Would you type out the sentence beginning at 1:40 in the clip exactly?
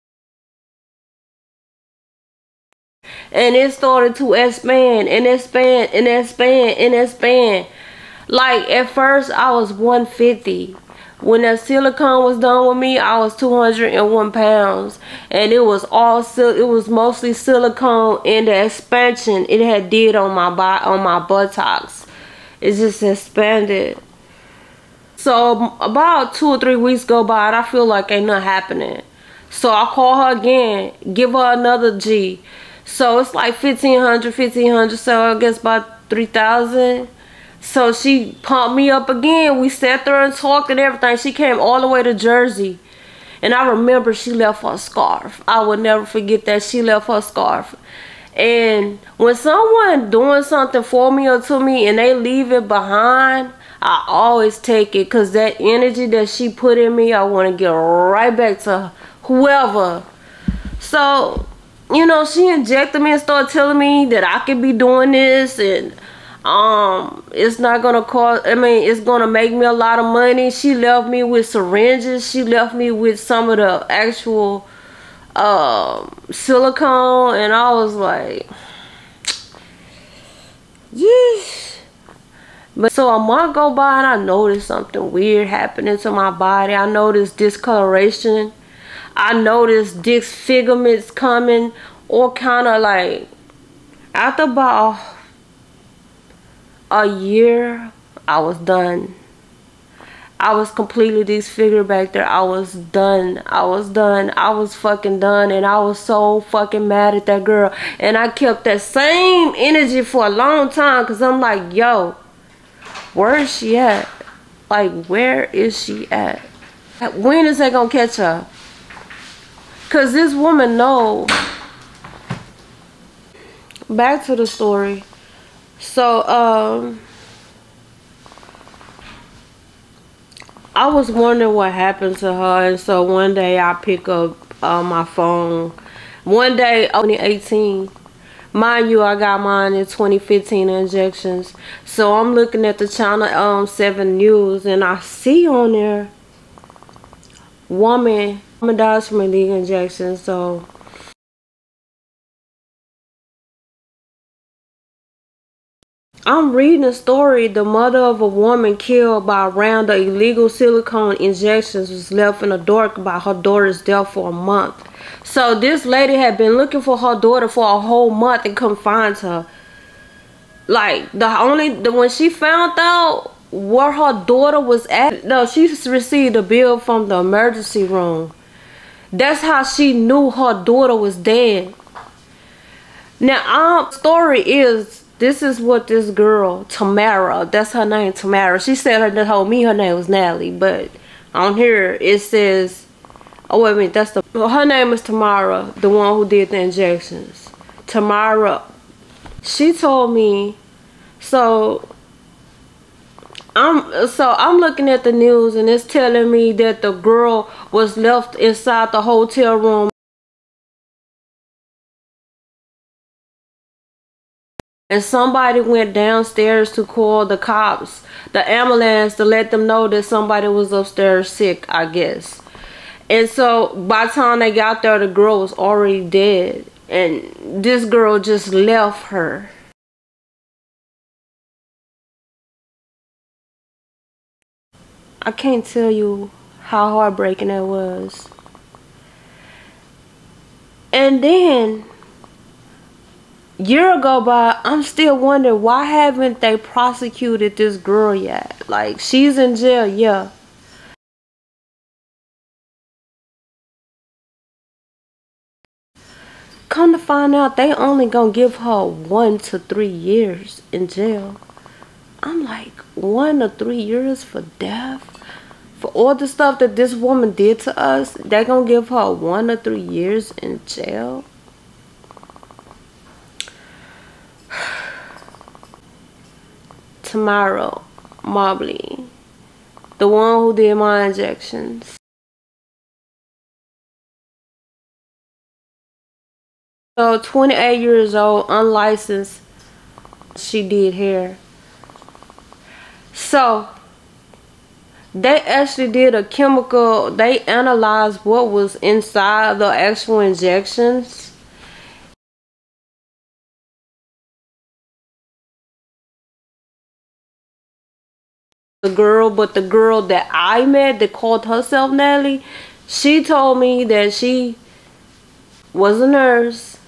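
I was completely disfigured back there.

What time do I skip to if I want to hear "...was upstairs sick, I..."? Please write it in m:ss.
3:40.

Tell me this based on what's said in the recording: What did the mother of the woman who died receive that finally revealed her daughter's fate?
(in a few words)
A bill from the emergency room.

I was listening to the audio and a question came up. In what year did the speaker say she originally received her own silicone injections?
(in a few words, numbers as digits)
2015.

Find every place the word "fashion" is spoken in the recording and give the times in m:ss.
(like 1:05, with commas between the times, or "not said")
not said.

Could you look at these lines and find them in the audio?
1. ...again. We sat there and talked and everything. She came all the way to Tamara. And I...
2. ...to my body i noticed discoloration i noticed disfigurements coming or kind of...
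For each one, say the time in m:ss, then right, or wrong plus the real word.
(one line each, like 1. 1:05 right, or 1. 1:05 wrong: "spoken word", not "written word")
1. 0:39 wrong: "Jersey", not "Tamara"
2. 1:25 right.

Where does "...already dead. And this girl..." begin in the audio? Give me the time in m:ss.
3:45.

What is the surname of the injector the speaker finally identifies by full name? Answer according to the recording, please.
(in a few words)
Mobley.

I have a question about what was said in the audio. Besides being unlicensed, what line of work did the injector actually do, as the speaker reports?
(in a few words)
Hair.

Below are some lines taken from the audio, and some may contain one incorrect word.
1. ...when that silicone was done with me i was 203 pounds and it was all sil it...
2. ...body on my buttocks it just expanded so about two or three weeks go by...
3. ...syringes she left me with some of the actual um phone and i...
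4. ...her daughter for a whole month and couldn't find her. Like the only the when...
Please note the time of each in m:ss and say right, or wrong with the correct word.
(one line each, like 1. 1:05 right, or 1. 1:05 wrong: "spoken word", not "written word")
1. 0:11 wrong: "201", not "203"
2. 0:20 right
3. 1:11 wrong: "silicone", not "phone"
4. 2:46 right.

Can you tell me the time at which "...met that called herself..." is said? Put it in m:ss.
5:10.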